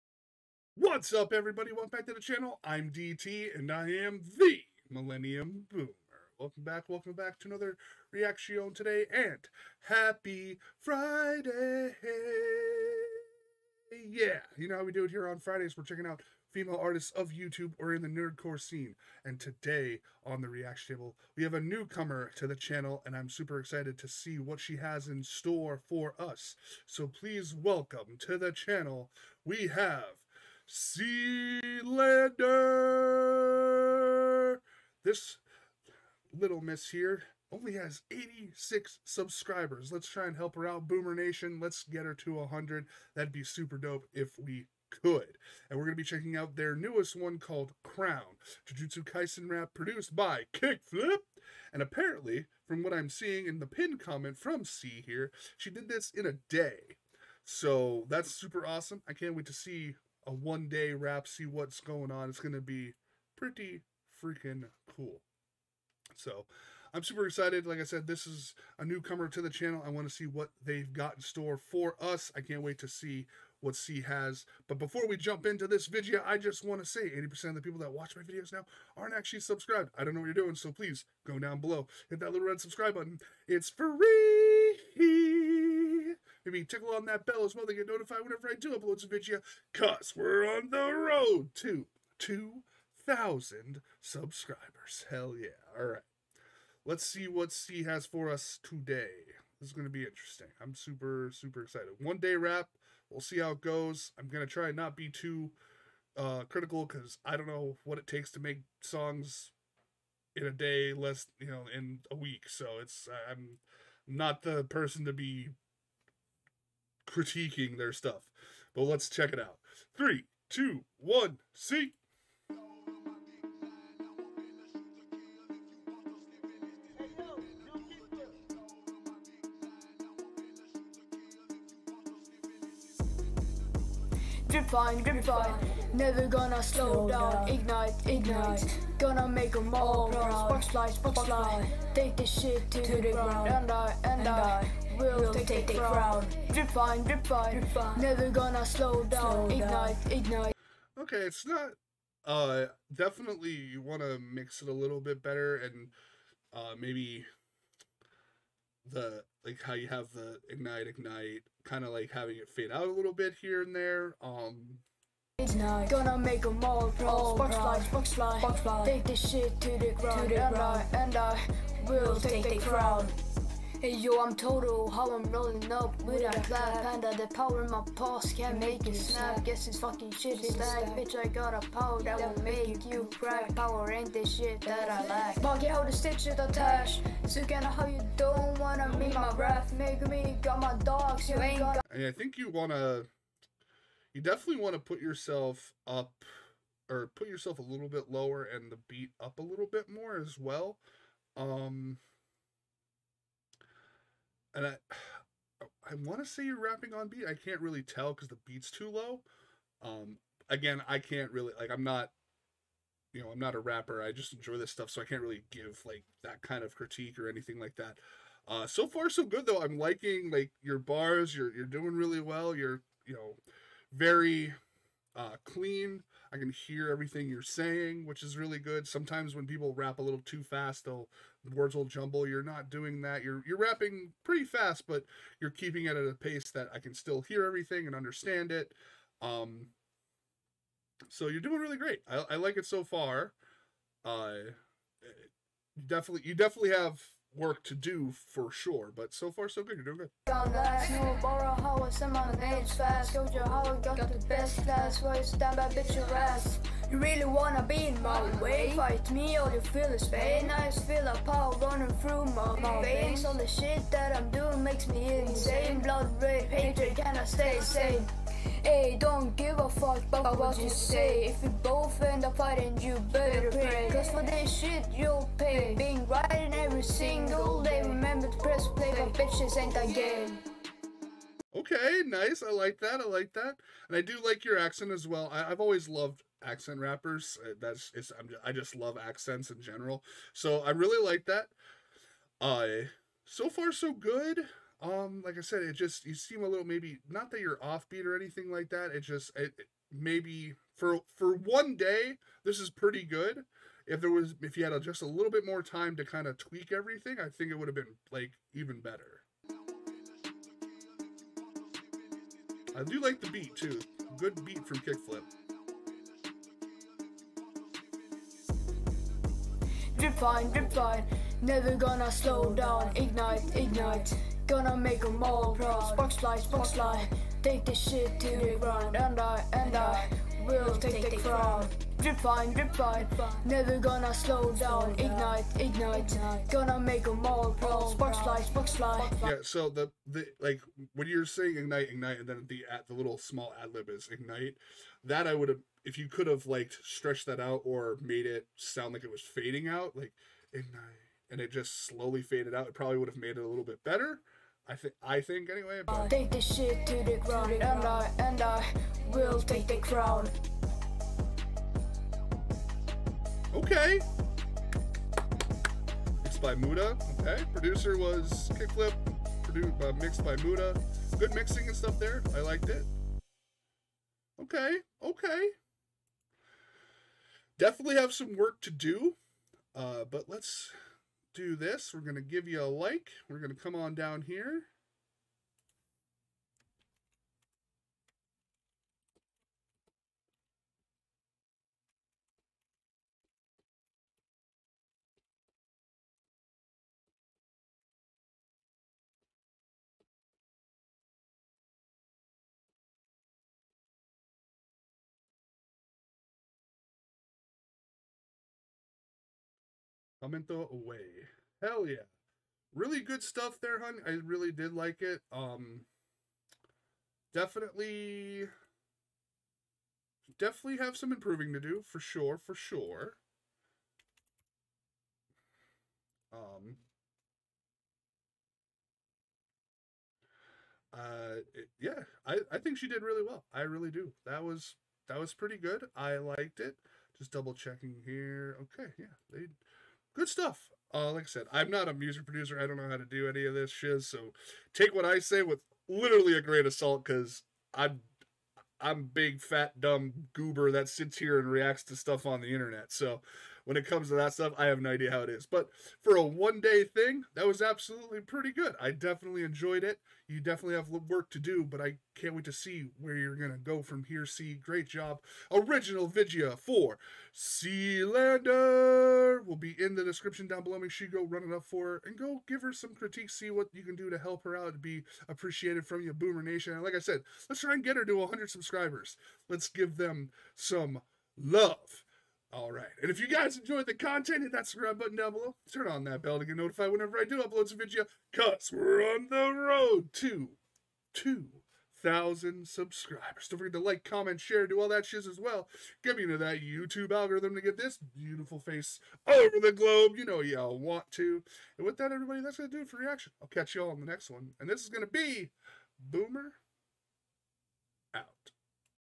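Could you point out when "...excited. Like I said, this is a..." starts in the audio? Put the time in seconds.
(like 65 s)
67 s.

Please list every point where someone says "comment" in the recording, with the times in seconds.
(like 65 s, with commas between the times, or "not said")
53 s, 494 s.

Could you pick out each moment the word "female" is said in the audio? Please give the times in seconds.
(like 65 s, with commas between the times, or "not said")
16 s.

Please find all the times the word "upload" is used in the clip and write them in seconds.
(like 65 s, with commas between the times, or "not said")
88 s, 487 s.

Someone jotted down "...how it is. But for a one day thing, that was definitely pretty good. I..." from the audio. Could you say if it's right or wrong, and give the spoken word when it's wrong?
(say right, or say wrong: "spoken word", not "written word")
wrong: "absolutely", not "definitely".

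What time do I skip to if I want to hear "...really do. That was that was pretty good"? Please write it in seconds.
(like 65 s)
433 s.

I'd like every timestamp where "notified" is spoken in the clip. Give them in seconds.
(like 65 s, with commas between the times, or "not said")
87 s, 486 s.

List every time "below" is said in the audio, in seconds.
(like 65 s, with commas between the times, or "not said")
81 s, 470 s, 485 s.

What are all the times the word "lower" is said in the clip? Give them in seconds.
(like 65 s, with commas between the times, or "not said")
198 s.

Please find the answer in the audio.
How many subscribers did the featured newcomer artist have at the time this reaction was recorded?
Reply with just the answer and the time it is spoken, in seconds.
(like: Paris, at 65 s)
86, at 38 s.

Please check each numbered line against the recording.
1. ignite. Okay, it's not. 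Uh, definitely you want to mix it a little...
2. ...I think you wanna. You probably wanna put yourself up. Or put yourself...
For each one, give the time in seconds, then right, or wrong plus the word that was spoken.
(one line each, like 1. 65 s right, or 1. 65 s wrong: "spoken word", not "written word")
1. 150 s right
2. 192 s wrong: "definitely", not "probably".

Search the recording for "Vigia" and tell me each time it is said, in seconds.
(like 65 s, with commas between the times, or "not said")
466 s.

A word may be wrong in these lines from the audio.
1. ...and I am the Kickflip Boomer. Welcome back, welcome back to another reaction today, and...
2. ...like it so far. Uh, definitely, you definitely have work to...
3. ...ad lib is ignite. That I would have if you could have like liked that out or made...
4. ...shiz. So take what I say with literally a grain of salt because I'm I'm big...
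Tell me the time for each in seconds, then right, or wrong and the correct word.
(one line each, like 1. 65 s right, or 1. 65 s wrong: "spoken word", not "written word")
1. 3 s wrong: "Millennium", not "Kickflip"
2. 242 s right
3. 343 s wrong: "stretched", not "liked"
4. 443 s right.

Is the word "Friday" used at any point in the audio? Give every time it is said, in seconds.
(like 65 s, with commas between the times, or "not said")
10 s, 15 s.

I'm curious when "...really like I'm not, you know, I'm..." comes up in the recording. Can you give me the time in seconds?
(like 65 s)
211 s.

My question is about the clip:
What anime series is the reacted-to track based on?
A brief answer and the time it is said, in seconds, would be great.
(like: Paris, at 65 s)
Jujutsu Kaisen, at 48 s.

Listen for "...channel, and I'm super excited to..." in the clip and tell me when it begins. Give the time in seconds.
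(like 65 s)
22 s.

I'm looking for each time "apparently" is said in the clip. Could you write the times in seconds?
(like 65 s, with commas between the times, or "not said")
51 s.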